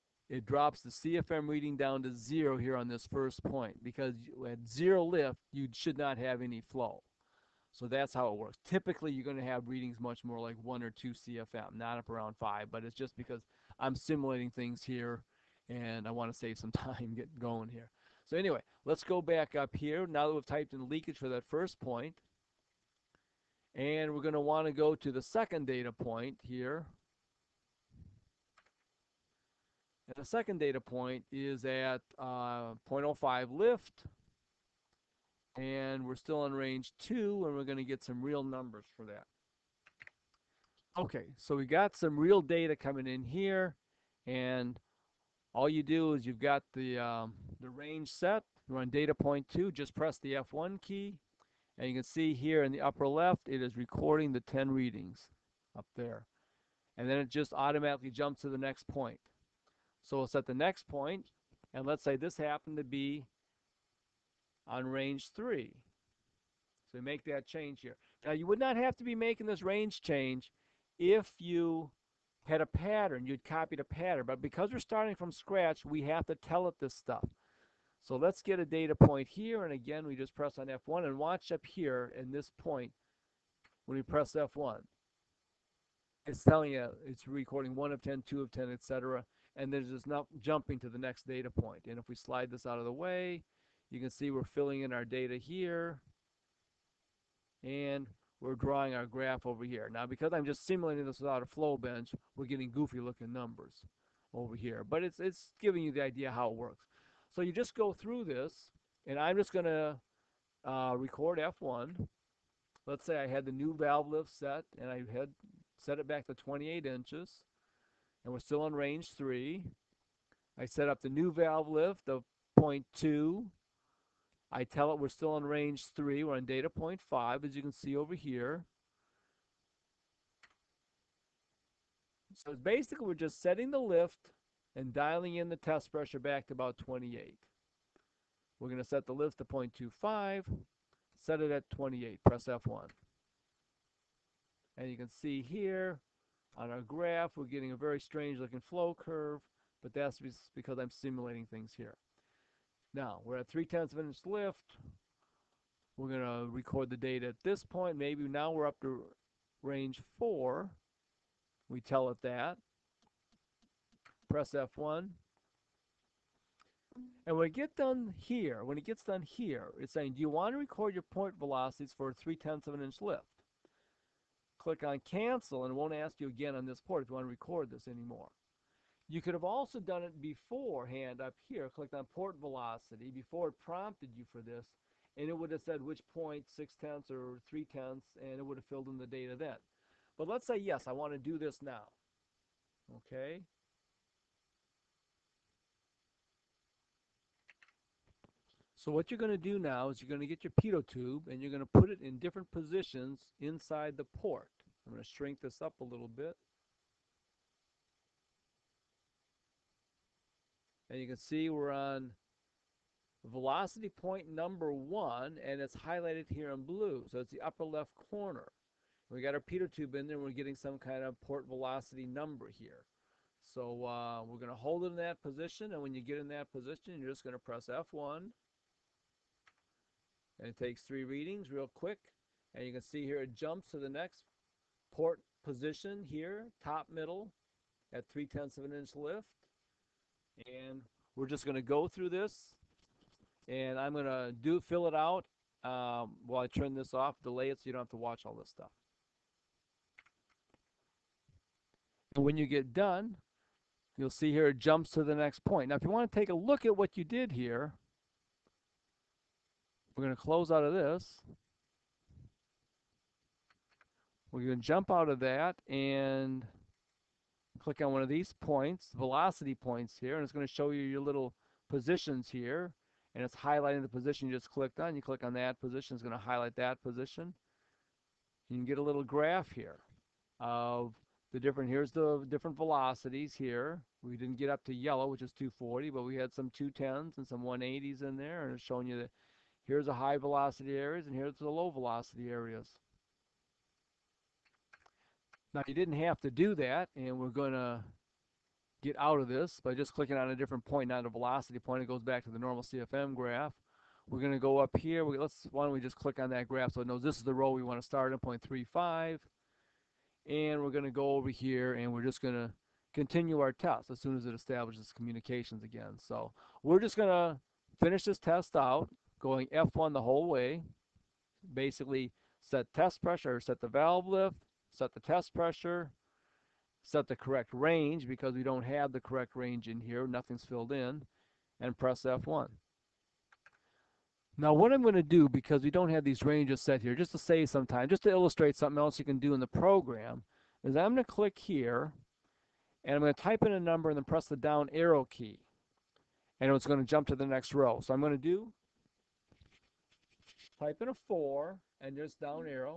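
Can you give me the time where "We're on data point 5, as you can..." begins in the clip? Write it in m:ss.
2:06.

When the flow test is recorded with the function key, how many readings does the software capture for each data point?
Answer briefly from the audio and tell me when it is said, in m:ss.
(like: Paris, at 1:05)
10, at 0:54.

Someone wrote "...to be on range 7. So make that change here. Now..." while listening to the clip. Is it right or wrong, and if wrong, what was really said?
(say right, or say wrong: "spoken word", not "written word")
wrong: "3", not "7".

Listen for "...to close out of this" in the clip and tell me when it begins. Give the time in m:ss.
4:20.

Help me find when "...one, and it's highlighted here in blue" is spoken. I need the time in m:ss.
3:34.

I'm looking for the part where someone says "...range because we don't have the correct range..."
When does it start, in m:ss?
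5:27.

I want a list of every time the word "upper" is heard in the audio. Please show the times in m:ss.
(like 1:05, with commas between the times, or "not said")
0:52, 3:37.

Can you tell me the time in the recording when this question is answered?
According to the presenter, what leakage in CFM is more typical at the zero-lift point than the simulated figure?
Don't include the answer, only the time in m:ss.
0:10.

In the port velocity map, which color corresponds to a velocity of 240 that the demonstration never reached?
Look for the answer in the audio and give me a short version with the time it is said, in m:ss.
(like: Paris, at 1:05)
Yellow, at 4:44.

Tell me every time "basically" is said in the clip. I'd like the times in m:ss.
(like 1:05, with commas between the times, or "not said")
2:12, 5:21.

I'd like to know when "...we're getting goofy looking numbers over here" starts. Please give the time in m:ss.
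1:42.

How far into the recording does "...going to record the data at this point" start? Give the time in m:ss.
2:36.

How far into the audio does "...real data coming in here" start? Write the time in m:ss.
0:42.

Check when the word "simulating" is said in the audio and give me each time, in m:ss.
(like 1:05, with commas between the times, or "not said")
0:13, 1:40, 2:30.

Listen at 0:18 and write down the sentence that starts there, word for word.
So anyway, let's go back up here.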